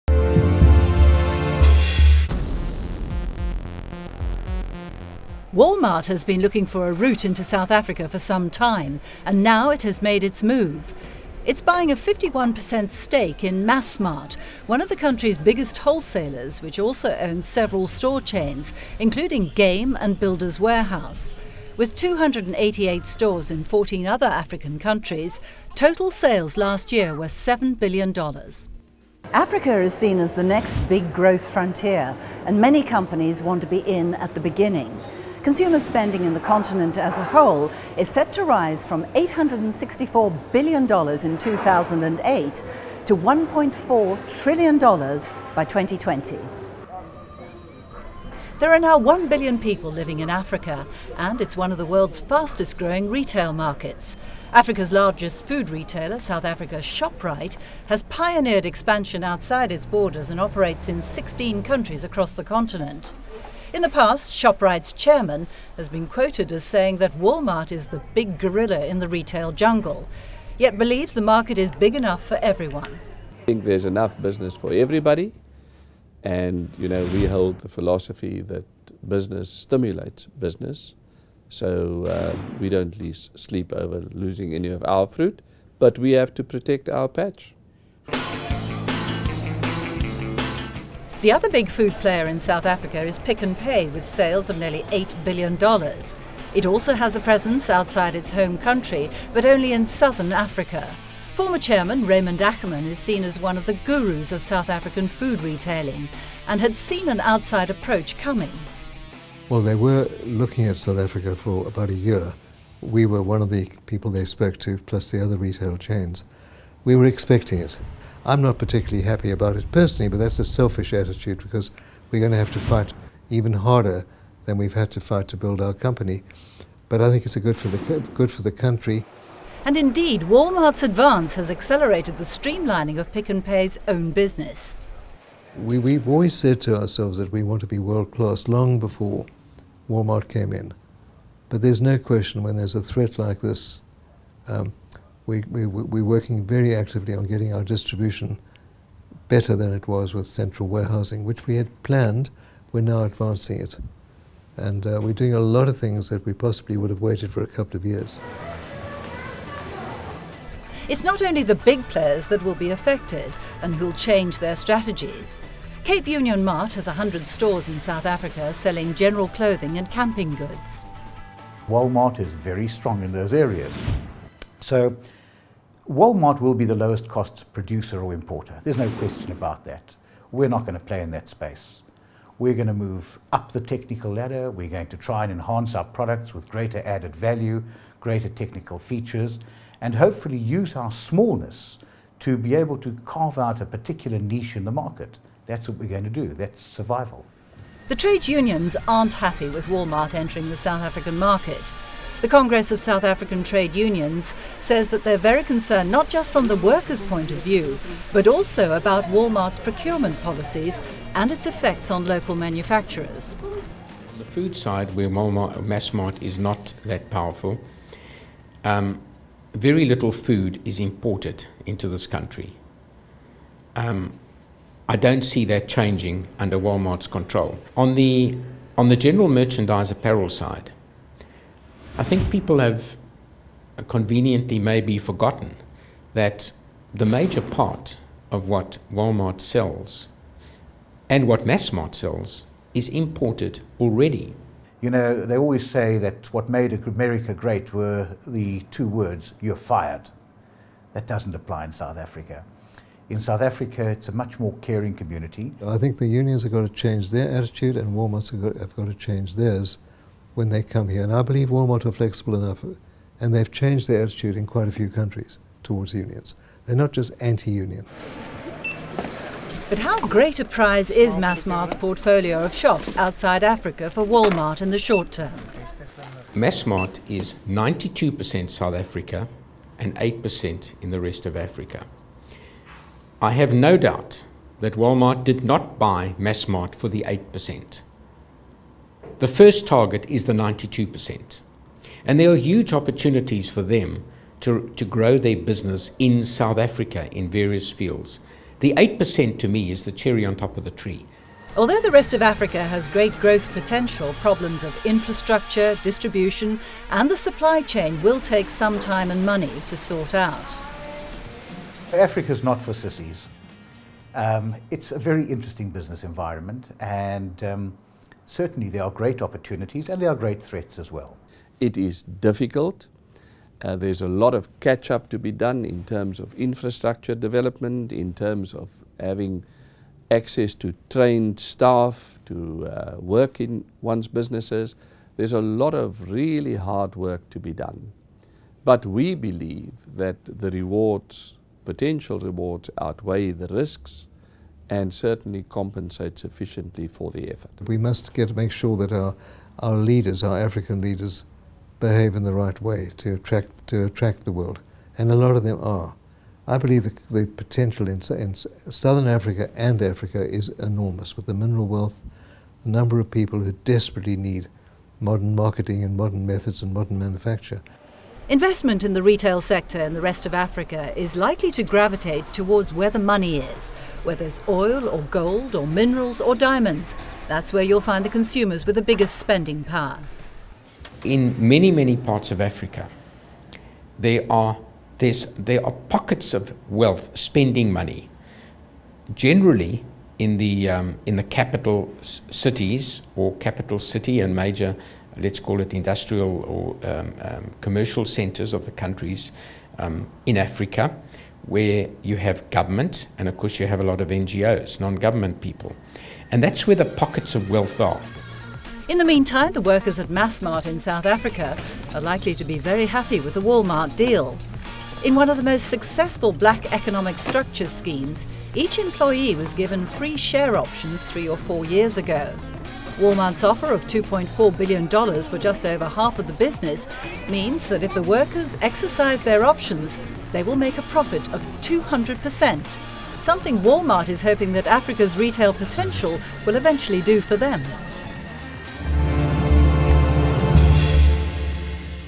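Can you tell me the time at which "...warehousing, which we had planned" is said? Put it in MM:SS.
02:30.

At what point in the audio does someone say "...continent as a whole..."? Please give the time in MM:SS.
00:36.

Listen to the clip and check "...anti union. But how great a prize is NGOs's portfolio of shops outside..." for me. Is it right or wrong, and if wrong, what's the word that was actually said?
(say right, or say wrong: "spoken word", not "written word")
wrong: "Massmart", not "NGOs".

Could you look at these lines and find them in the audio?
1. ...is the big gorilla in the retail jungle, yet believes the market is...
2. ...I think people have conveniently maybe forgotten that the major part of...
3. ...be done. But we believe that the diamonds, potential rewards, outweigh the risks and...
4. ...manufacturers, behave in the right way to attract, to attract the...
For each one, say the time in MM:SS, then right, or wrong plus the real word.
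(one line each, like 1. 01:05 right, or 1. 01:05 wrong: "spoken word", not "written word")
1. 01:07 right
2. 03:51 right
3. 05:37 wrong: "rewards", not "diamonds"
4. 05:50 wrong: "leaders", not "manufacturers".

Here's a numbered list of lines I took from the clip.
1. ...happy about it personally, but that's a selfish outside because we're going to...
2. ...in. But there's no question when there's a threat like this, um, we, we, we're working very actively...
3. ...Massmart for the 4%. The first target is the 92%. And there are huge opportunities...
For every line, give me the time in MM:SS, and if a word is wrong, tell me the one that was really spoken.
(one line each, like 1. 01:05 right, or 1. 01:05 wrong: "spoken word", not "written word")
1. 01:59 wrong: "attitude", not "outside"
2. 02:20 right
3. 04:46 wrong: "8", not "4".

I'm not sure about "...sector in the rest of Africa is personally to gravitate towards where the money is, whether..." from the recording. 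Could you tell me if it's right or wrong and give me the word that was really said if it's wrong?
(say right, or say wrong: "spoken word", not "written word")
wrong: "likely", not "personally".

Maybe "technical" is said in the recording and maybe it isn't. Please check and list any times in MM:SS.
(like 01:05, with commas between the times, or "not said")
03:03, 03:08.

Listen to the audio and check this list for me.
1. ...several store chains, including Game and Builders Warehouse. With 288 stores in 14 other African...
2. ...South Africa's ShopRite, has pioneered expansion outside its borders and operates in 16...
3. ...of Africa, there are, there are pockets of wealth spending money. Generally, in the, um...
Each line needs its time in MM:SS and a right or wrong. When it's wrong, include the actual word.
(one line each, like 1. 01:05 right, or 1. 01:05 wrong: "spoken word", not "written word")
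1. 00:17 right
2. 00:56 right
3. 06:22 right.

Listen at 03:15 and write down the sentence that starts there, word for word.
That's what we're going to do.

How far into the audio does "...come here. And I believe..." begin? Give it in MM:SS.
04:20.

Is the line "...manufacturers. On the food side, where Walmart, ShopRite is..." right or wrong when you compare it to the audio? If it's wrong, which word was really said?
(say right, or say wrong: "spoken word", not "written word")
wrong: "MassMart", not "ShopRite".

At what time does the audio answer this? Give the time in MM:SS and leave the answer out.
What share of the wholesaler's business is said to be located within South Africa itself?
04:37.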